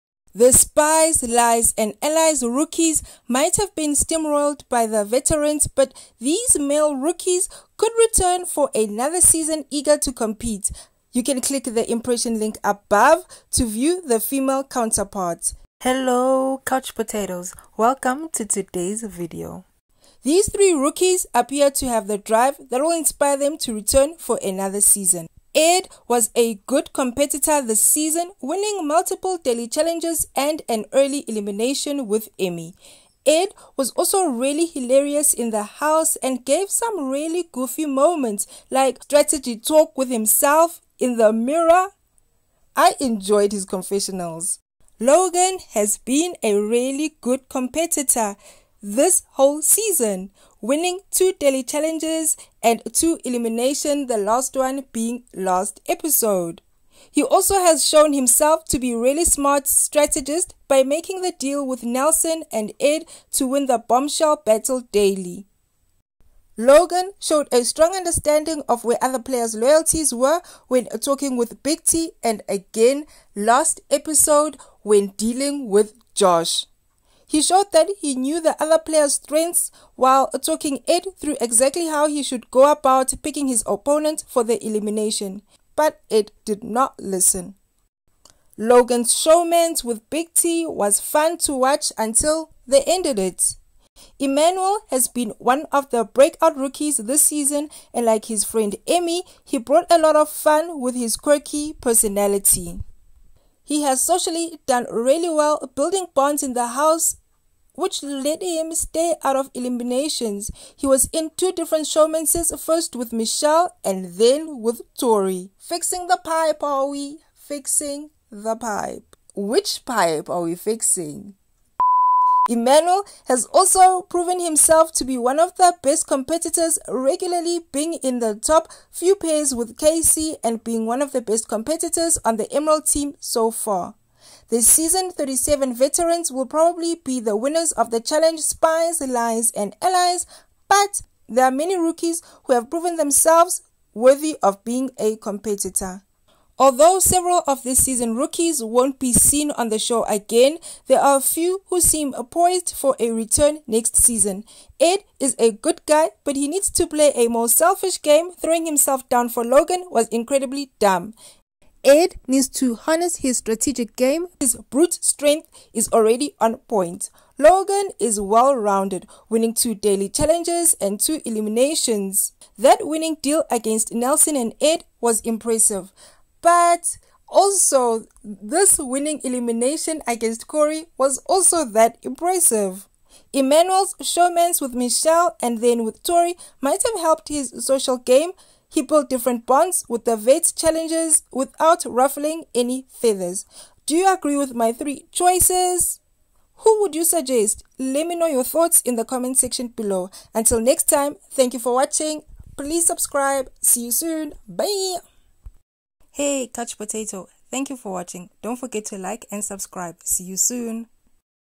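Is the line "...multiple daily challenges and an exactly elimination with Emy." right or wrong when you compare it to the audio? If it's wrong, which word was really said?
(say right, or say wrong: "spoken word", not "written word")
wrong: "early", not "exactly".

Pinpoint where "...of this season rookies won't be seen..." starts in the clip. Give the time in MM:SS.
02:27.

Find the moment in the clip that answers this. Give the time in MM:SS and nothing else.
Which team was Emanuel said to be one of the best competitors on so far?
02:12.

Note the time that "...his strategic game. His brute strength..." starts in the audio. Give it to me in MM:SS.
02:43.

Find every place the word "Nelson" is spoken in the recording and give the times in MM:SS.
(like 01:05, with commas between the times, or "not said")
01:01, 02:53.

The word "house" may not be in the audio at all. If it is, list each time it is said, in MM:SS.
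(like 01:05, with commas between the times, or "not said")
00:35, 01:46.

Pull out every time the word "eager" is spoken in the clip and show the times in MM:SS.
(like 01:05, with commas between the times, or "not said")
00:09.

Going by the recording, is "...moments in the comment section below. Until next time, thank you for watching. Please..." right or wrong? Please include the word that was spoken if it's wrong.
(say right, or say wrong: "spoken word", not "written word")
wrong: "thoughts", not "moments".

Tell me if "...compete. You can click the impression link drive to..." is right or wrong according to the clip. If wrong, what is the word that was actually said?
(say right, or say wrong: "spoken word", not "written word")
wrong: "above", not "drive".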